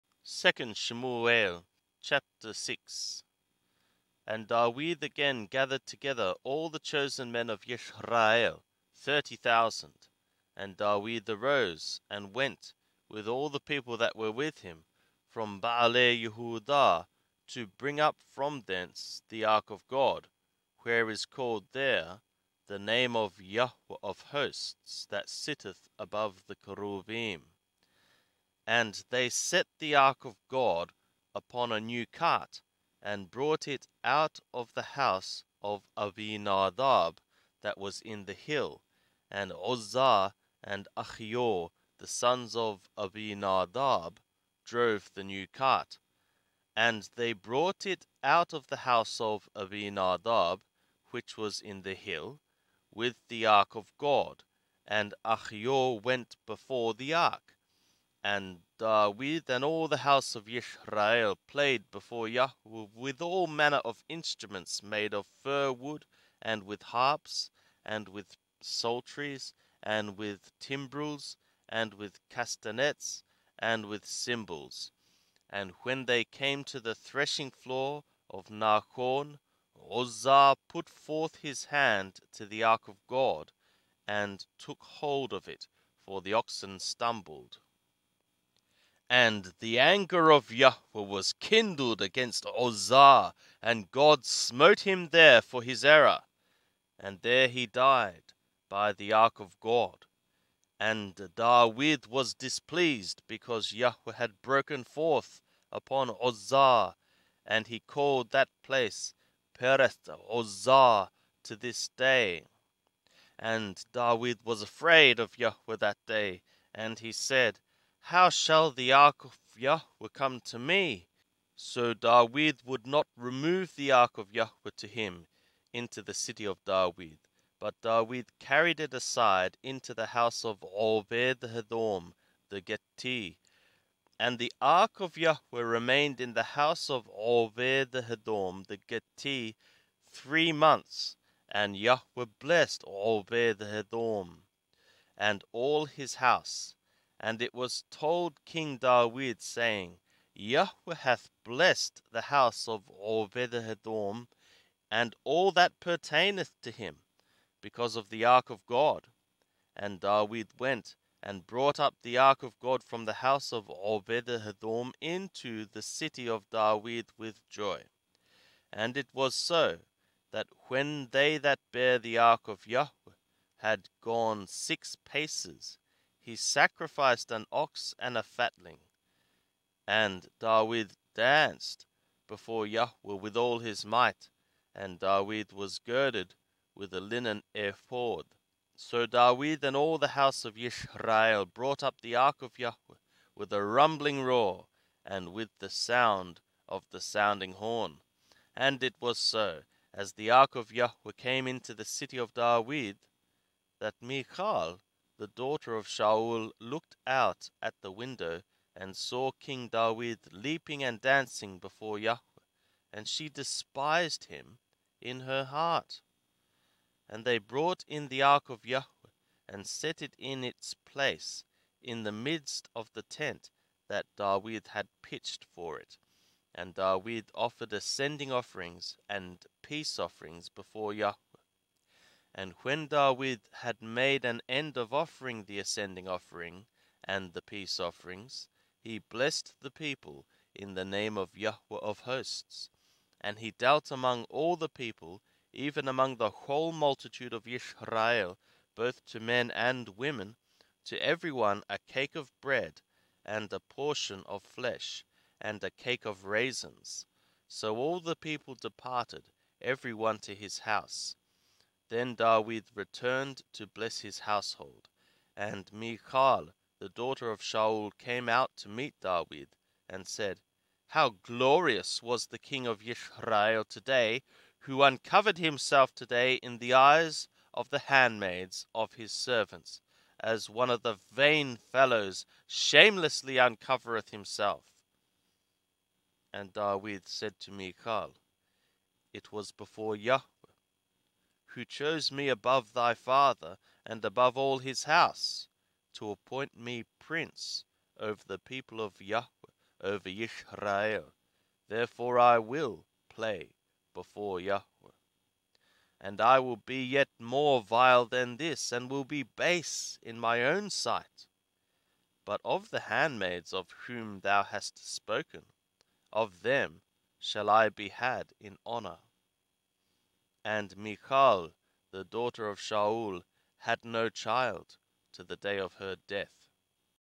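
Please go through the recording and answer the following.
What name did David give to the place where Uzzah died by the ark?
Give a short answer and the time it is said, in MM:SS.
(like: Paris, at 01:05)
Pereth Uzzah, at 01:49.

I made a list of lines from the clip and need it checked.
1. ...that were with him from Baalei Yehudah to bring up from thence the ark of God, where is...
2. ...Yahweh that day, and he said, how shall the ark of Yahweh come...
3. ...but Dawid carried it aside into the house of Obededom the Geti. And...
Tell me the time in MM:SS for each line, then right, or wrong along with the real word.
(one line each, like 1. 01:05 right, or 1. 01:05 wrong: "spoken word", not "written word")
1. 00:13 right
2. 01:55 right
3. 02:07 right.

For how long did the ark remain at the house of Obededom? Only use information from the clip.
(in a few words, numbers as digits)
3 months.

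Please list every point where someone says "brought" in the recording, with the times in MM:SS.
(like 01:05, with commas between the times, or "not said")
00:33, 00:47, 02:41, 03:11, 03:37.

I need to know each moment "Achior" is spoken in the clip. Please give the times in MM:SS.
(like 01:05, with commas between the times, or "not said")
00:40, 00:55.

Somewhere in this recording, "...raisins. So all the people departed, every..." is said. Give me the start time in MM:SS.
04:16.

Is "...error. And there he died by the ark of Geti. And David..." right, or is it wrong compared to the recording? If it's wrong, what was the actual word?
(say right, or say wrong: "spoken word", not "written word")
wrong: "God", not "Geti".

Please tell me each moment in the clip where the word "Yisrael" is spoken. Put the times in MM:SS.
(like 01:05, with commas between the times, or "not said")
00:07, 03:10, 05:00.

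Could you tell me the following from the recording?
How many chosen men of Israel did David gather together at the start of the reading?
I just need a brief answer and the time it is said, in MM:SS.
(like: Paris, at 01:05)
30,000, at 00:08.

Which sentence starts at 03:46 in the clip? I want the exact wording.
And David offered ascending offerings and peace offerings before Yahweh.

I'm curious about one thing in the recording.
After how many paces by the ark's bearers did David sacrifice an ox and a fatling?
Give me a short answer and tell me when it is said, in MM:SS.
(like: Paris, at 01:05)
6, at 02:54.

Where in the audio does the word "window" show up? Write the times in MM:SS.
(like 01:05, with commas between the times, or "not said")
03:27.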